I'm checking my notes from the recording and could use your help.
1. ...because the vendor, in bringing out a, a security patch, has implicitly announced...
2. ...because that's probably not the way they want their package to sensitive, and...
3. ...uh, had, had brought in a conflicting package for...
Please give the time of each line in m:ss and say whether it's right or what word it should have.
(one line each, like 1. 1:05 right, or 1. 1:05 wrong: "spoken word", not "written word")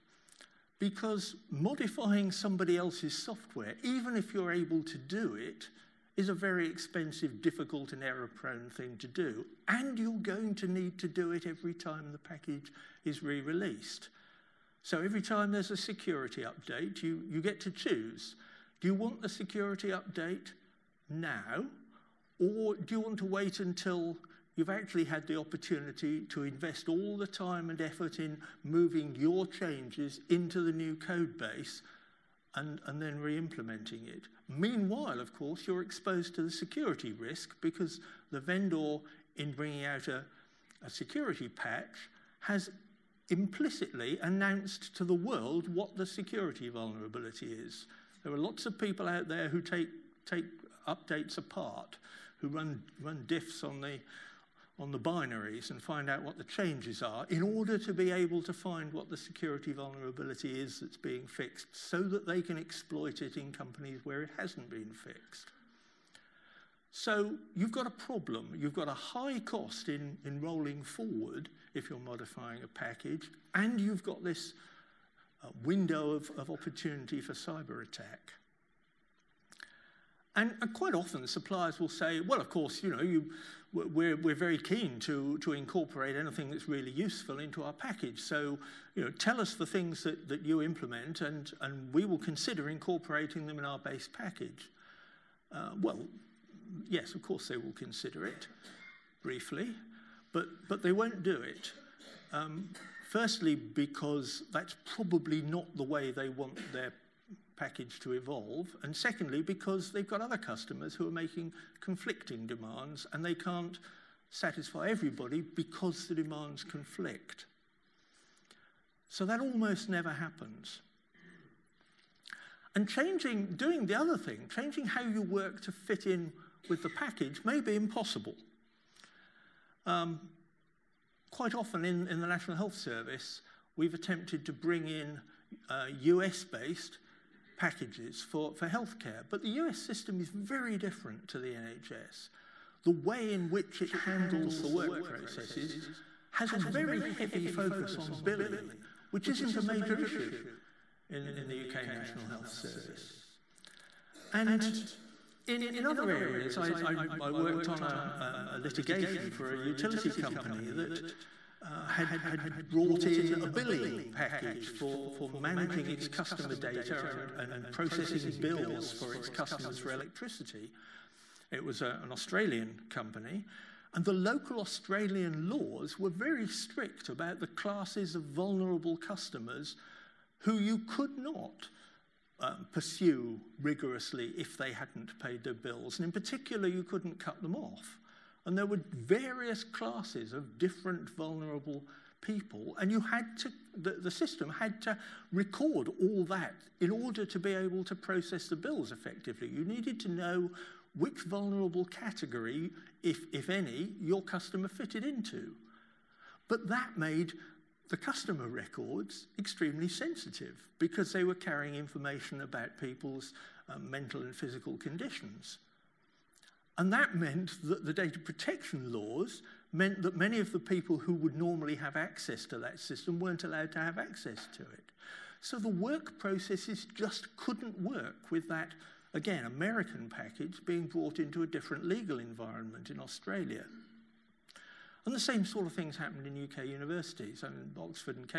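1. 0:37 right
2. 1:43 wrong: "evolve", not "sensitive"
3. 2:41 wrong: "billing", not "conflicting".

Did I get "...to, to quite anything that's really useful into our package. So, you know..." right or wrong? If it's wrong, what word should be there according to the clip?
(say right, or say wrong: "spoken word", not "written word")
wrong: "incorporate", not "quite".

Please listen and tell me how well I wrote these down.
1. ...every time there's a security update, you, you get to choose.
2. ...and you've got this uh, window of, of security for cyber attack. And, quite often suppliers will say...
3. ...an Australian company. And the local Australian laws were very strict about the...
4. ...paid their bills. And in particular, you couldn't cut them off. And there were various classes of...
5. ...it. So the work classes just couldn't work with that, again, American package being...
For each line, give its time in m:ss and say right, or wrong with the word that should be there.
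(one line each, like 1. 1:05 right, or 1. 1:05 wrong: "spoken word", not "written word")
1. 0:14 right
2. 1:13 wrong: "opportunity", not "security"
3. 2:52 right
4. 3:05 right
5. 3:44 wrong: "processes", not "classes".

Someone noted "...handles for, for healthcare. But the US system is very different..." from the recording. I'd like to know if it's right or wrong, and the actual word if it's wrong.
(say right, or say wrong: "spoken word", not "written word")
wrong: "packages", not "handles".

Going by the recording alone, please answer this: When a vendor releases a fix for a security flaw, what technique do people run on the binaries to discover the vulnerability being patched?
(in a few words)
Diffs.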